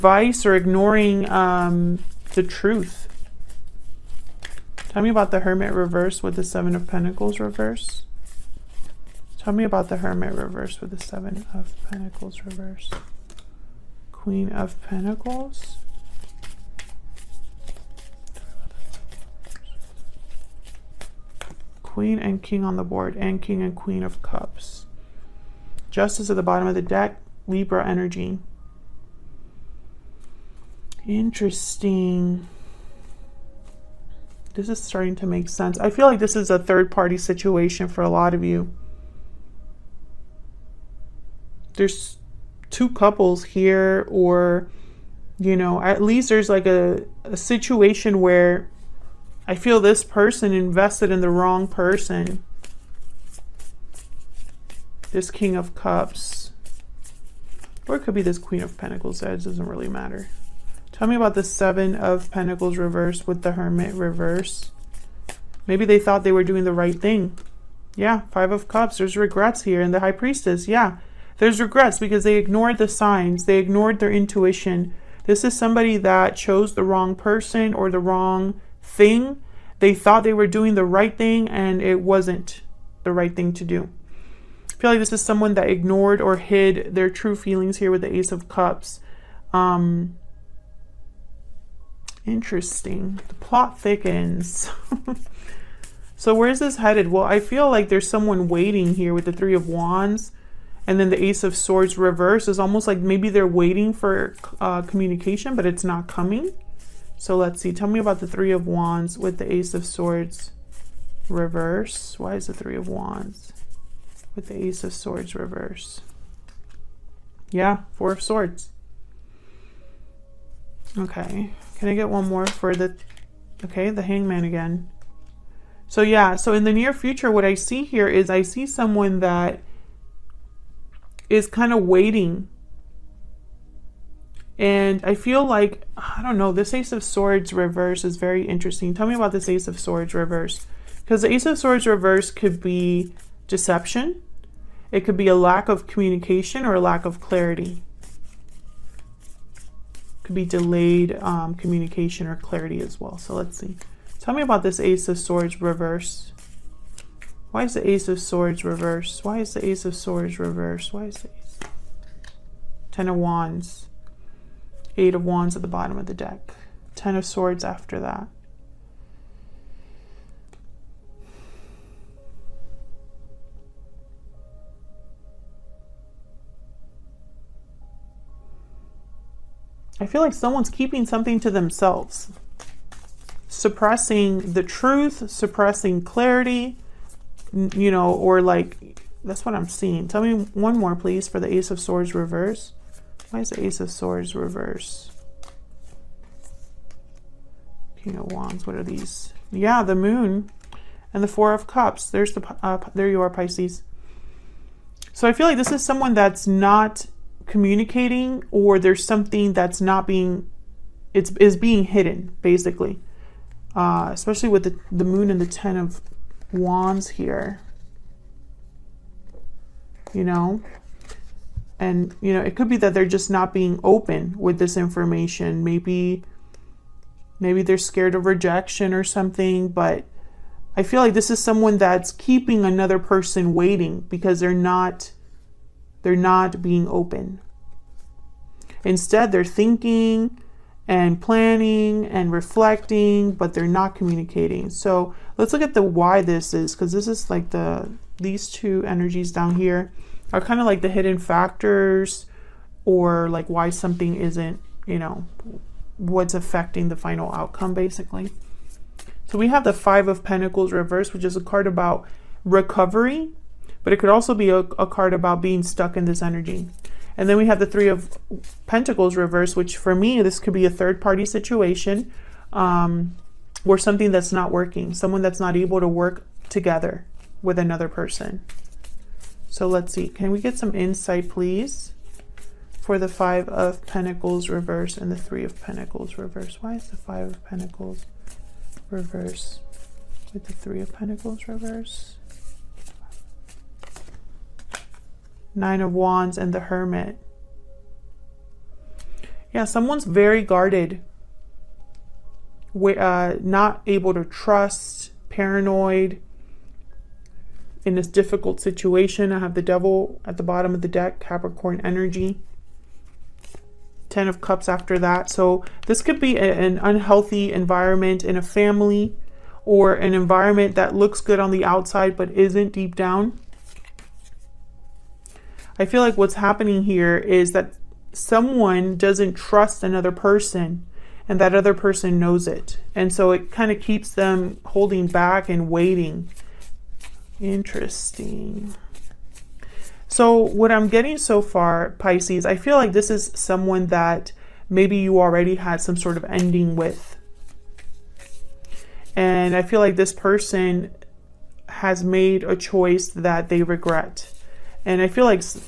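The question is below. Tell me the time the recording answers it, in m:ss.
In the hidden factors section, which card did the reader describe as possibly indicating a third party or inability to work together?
4:27.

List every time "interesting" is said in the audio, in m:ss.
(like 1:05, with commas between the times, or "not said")
0:31, 1:32, 2:18, 5:37.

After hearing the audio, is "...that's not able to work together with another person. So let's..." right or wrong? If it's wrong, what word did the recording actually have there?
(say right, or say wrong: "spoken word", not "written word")
right.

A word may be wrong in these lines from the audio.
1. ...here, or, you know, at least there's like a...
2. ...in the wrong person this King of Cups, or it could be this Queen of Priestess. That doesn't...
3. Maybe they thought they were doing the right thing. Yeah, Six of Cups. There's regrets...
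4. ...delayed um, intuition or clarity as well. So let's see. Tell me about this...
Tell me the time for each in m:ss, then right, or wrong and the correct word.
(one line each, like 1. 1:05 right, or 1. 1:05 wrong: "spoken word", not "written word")
1. 0:43 right
2. 0:51 wrong: "Pentacles", not "Priestess"
3. 1:05 wrong: "Five", not "Six"
4. 2:30 wrong: "communication", not "intuition".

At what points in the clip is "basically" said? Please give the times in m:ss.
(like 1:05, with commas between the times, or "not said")
3:32, 4:17.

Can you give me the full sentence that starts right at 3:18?
King of Wands, what are these?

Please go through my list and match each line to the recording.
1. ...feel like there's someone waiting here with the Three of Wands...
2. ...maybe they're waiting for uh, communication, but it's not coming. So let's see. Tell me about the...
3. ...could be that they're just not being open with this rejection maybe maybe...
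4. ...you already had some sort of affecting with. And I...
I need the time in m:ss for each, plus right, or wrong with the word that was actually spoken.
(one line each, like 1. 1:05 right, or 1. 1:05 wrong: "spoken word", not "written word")
1. 1:37 right
2. 1:42 right
3. 3:42 wrong: "information", not "rejection"
4. 5:44 wrong: "ending", not "affecting".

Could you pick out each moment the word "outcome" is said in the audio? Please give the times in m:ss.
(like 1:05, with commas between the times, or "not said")
4:17.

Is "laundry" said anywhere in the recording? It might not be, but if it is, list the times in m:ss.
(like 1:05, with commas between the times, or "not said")
not said.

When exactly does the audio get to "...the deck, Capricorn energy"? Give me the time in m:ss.
5:10.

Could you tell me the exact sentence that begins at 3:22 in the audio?
There's the, uh, there you are, Pisces.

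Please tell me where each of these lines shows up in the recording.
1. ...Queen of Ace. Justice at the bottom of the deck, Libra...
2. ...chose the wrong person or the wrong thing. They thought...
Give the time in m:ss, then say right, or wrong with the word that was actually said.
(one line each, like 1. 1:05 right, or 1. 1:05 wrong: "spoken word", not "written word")
1. 0:23 wrong: "Cups", not "Ace"
2. 1:16 right.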